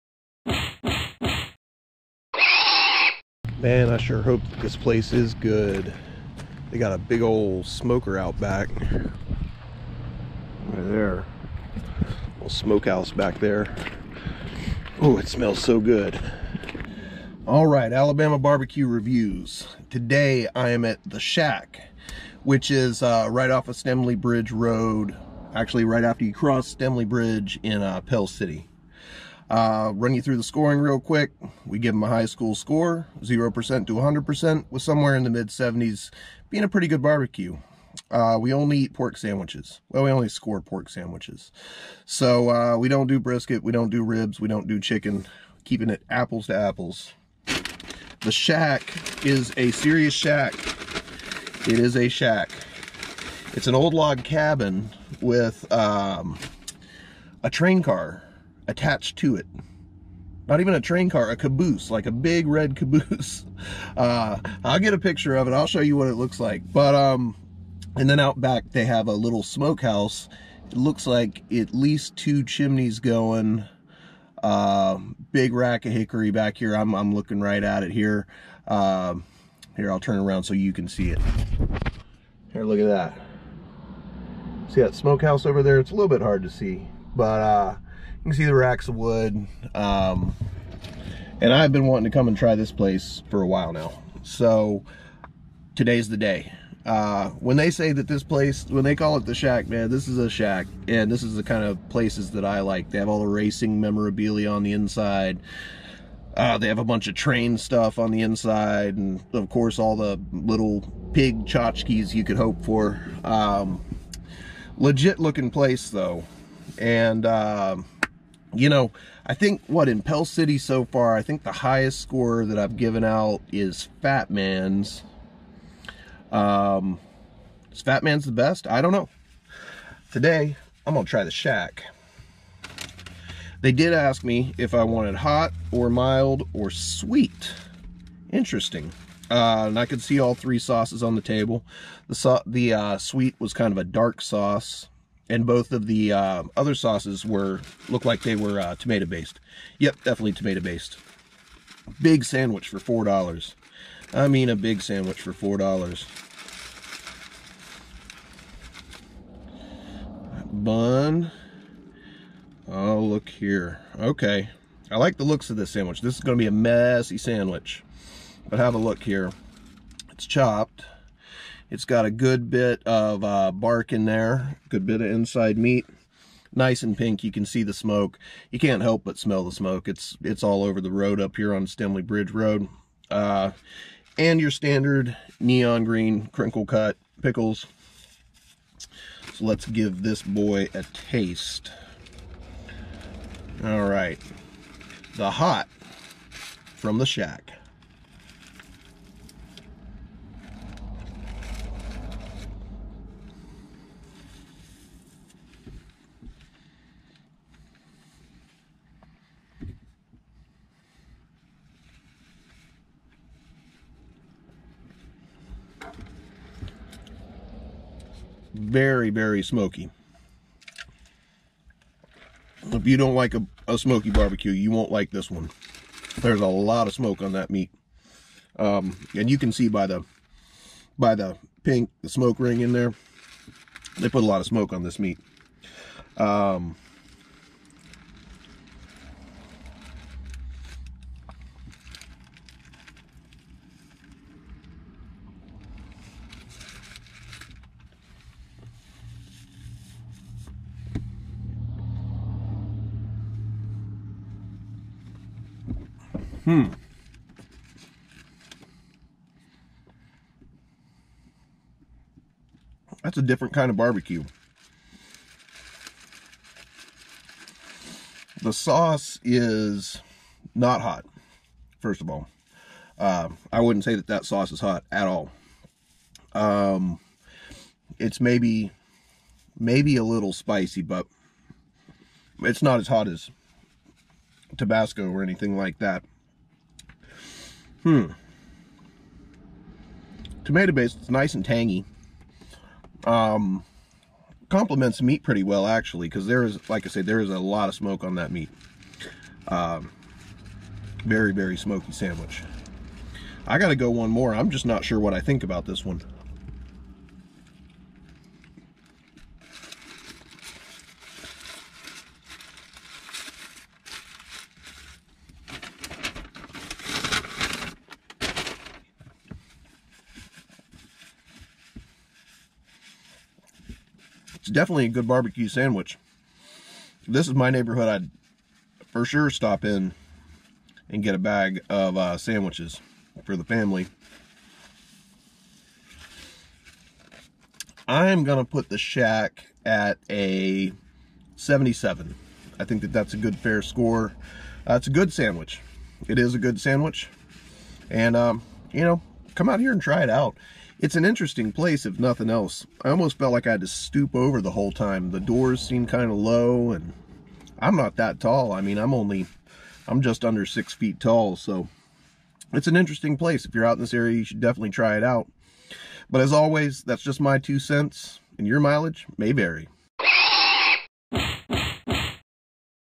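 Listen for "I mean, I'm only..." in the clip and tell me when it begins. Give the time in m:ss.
5:58.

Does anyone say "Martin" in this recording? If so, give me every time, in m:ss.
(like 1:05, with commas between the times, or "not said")
not said.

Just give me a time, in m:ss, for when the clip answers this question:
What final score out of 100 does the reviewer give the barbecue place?
5:41.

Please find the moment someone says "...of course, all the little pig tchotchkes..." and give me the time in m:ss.
1:49.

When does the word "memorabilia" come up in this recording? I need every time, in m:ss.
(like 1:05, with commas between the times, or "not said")
1:43.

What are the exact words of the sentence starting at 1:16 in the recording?
I'm, I'm looking right at it here.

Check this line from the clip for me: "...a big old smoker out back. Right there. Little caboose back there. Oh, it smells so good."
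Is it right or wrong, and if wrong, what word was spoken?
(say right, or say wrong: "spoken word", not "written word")
wrong: "smokehouse", not "caboose".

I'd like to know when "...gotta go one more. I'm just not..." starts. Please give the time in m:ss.
5:03.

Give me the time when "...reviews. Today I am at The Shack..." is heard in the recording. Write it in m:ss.
0:18.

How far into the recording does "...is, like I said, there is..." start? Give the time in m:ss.
4:56.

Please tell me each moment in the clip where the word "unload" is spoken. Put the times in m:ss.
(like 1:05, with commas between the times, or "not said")
not said.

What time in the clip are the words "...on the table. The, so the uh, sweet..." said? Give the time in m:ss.
2:21.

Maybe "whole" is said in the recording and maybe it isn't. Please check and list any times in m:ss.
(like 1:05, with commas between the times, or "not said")
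5:54.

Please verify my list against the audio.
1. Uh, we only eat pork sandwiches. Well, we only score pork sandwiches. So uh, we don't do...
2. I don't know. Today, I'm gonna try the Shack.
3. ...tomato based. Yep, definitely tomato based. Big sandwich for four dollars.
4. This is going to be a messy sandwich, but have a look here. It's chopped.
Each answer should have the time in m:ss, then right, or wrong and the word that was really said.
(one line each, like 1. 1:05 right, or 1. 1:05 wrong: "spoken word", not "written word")
1. 0:38 right
2. 2:08 right
3. 2:28 right
4. 2:46 right.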